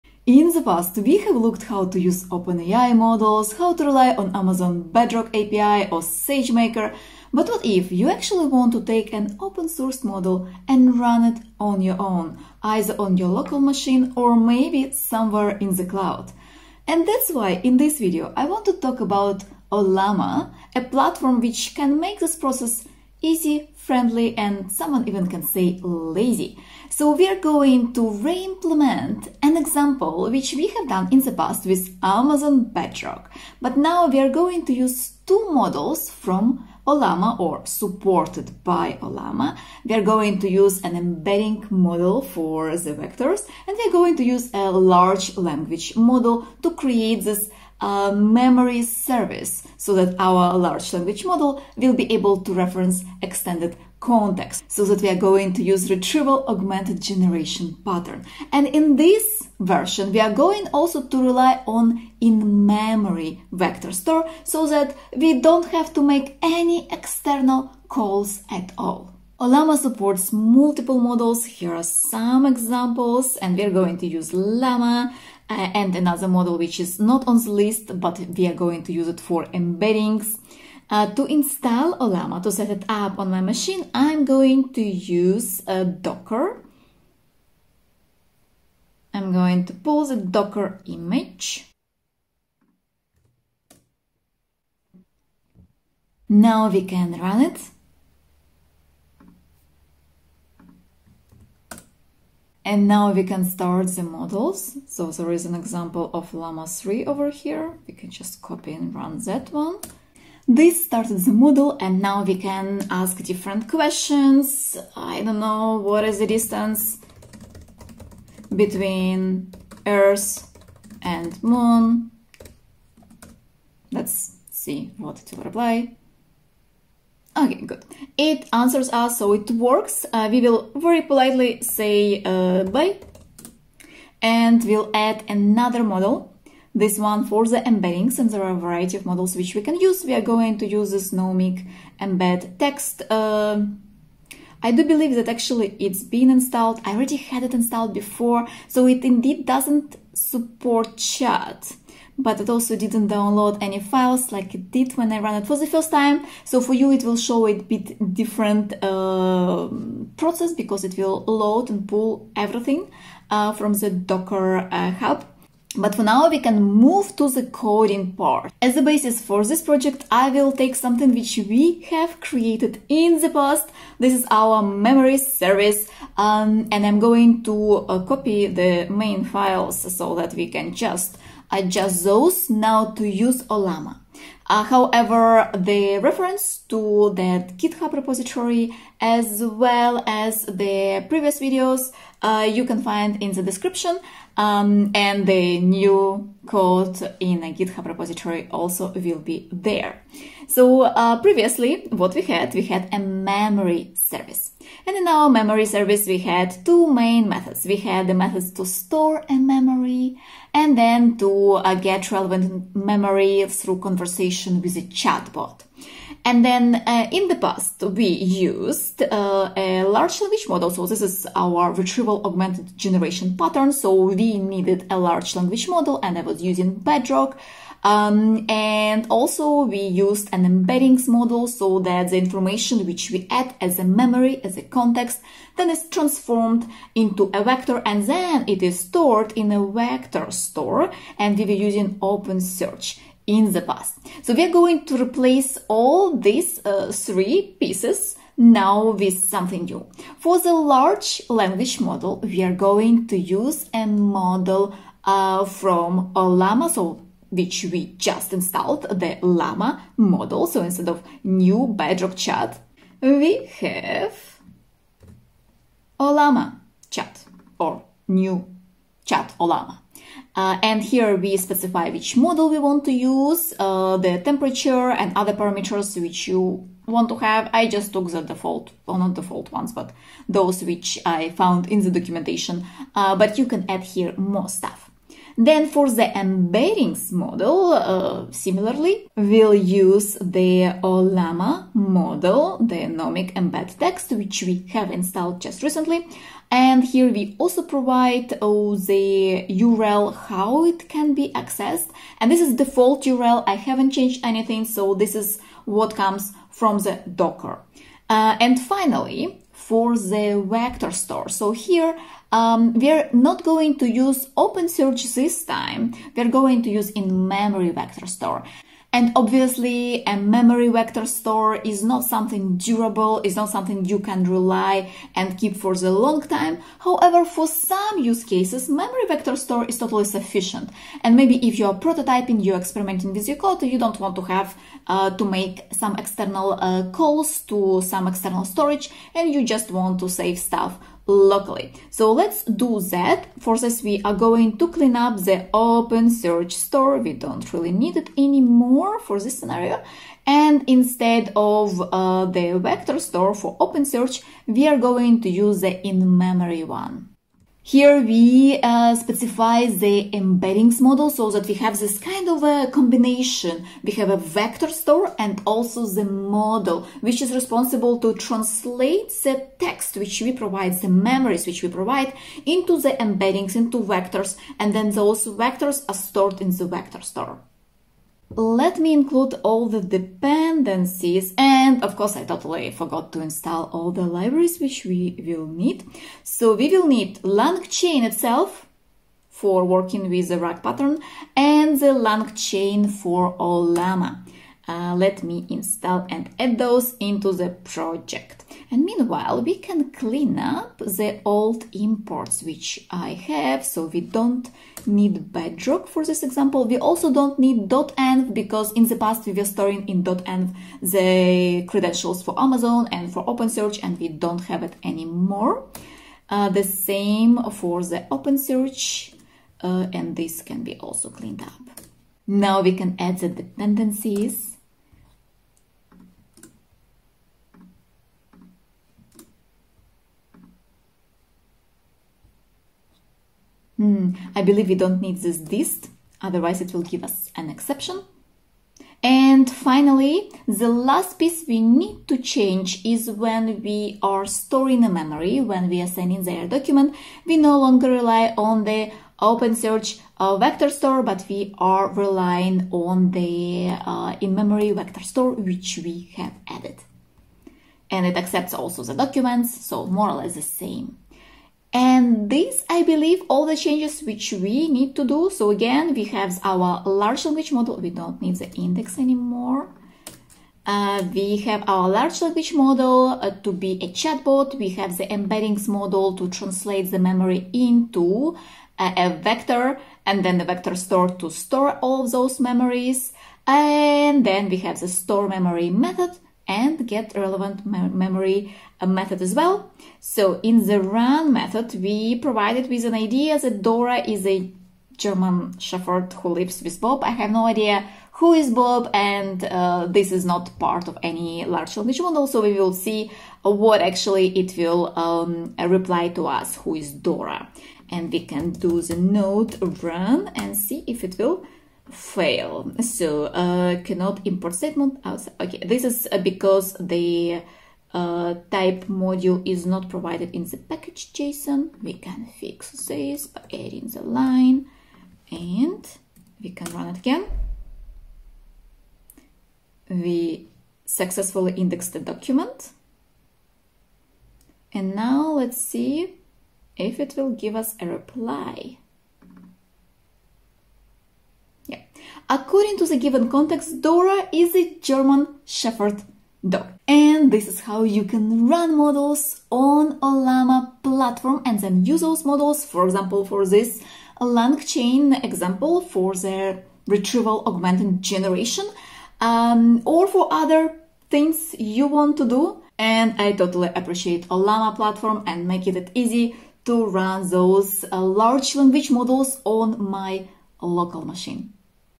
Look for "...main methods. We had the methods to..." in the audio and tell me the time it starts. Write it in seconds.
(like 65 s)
206 s.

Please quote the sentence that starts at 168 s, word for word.
As the basis for this project, I will take something which we have created in the past.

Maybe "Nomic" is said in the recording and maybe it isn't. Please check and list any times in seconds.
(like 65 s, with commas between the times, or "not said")
141 s, 292 s.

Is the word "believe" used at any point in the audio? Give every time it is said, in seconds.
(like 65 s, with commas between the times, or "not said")
144 s, 434 s, 462 s.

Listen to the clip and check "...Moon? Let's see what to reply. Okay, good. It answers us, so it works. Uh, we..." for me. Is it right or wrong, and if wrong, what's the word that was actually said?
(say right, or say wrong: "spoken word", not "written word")
right.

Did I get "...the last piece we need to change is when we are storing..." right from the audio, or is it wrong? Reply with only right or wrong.
right.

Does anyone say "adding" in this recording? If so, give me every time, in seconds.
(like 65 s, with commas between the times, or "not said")
523 s.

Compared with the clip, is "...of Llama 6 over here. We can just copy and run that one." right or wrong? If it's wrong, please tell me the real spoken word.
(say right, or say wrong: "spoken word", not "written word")
wrong: "3", not "6".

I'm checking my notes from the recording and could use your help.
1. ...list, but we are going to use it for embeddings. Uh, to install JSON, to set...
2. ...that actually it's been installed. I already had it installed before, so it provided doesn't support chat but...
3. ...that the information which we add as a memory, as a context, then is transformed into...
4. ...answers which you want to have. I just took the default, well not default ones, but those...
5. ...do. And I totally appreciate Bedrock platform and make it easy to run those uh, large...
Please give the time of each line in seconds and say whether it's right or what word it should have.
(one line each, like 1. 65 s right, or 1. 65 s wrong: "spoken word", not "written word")
1. 77 s wrong: "Ollama", not "JSON"
2. 145 s wrong: "indeed", not "provided"
3. 231 s right
4. 275 s wrong: "parameters", not "answers"
5. 562 s wrong: "Ollama", not "Bedrock".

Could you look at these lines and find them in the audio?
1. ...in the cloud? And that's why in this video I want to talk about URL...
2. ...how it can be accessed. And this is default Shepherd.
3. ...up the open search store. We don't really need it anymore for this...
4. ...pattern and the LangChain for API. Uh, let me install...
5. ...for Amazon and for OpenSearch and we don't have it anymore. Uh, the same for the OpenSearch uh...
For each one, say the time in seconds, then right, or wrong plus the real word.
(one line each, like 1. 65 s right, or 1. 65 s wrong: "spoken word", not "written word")
1. 15 s wrong: "Ollama", not "URL"
2. 300 s wrong: "URL", not "Shepherd"
3. 344 s right
4. 390 s wrong: "Ollama", not "API"
5. 412 s right.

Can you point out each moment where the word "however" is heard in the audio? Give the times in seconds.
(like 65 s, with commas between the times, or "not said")
184 s, 326 s.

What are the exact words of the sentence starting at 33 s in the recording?
But now we are going to use two models from Ollama or supported by Ollama.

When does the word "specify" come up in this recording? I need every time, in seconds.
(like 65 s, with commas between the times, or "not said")
271 s, 358 s.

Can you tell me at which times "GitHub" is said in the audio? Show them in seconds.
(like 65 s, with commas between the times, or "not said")
187 s, 197 s.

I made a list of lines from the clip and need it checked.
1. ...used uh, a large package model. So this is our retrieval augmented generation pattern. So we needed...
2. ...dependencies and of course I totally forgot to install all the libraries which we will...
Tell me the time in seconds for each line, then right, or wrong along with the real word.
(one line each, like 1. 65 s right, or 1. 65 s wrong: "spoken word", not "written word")
1. 218 s wrong: "language", not "package"
2. 379 s right.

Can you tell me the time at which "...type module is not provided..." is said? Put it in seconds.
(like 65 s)
518 s.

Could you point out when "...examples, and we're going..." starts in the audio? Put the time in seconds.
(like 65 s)
72 s.